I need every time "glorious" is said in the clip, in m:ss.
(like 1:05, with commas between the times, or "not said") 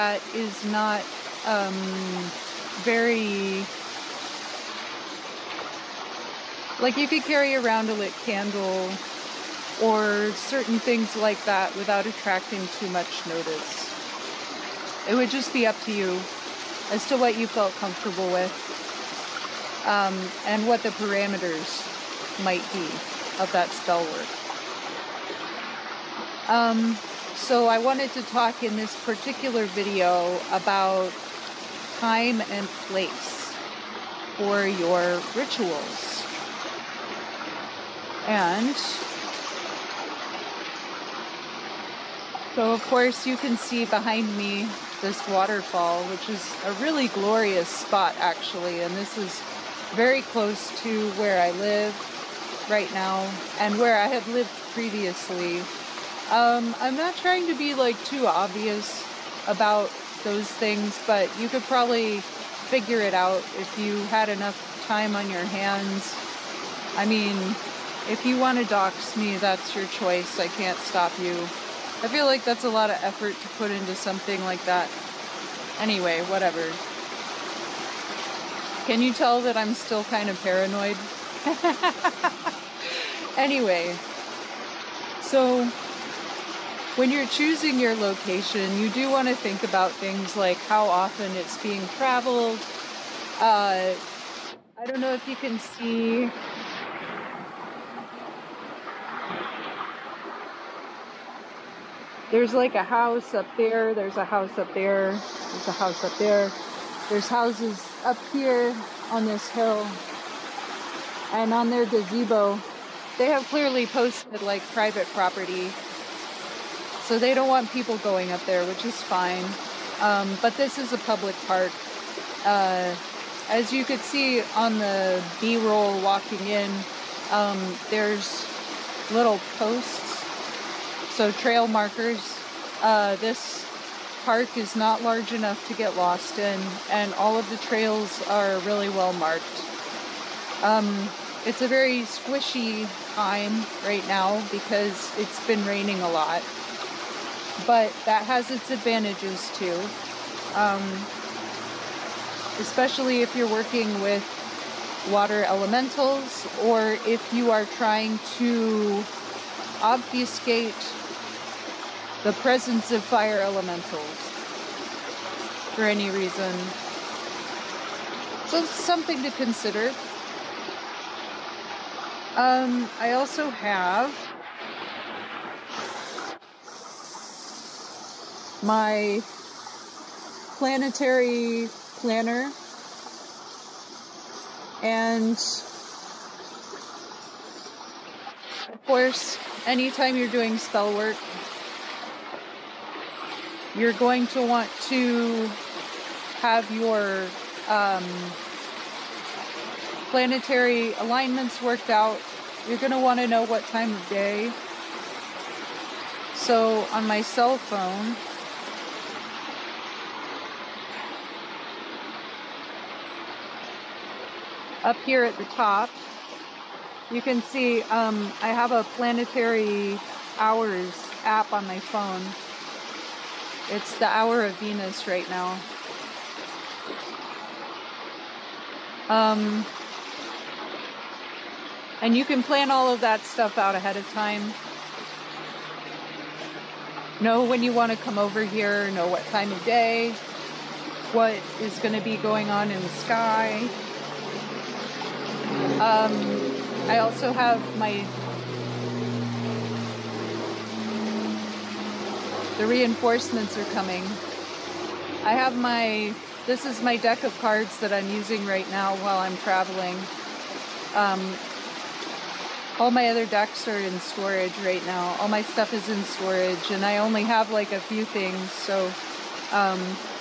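0:47.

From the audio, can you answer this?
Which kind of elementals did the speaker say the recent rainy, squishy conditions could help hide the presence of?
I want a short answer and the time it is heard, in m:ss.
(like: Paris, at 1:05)
fire elementals, at 2:43.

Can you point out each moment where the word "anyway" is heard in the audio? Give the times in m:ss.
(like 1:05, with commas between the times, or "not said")
1:15, 1:23.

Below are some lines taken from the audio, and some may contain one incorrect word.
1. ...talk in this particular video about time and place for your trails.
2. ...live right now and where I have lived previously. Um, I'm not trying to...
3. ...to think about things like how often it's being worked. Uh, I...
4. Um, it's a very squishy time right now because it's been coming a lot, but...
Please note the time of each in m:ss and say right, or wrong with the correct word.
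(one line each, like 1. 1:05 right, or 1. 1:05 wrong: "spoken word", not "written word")
1. 0:28 wrong: "rituals", not "trails"
2. 0:51 right
3. 1:29 wrong: "traveled", not "worked"
4. 2:20 wrong: "raining", not "coming".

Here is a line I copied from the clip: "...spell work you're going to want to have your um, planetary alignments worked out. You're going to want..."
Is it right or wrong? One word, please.
right.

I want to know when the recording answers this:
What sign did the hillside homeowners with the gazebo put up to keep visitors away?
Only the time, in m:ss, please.
1:54.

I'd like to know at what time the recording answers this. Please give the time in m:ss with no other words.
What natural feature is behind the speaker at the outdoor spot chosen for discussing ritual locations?
0:45.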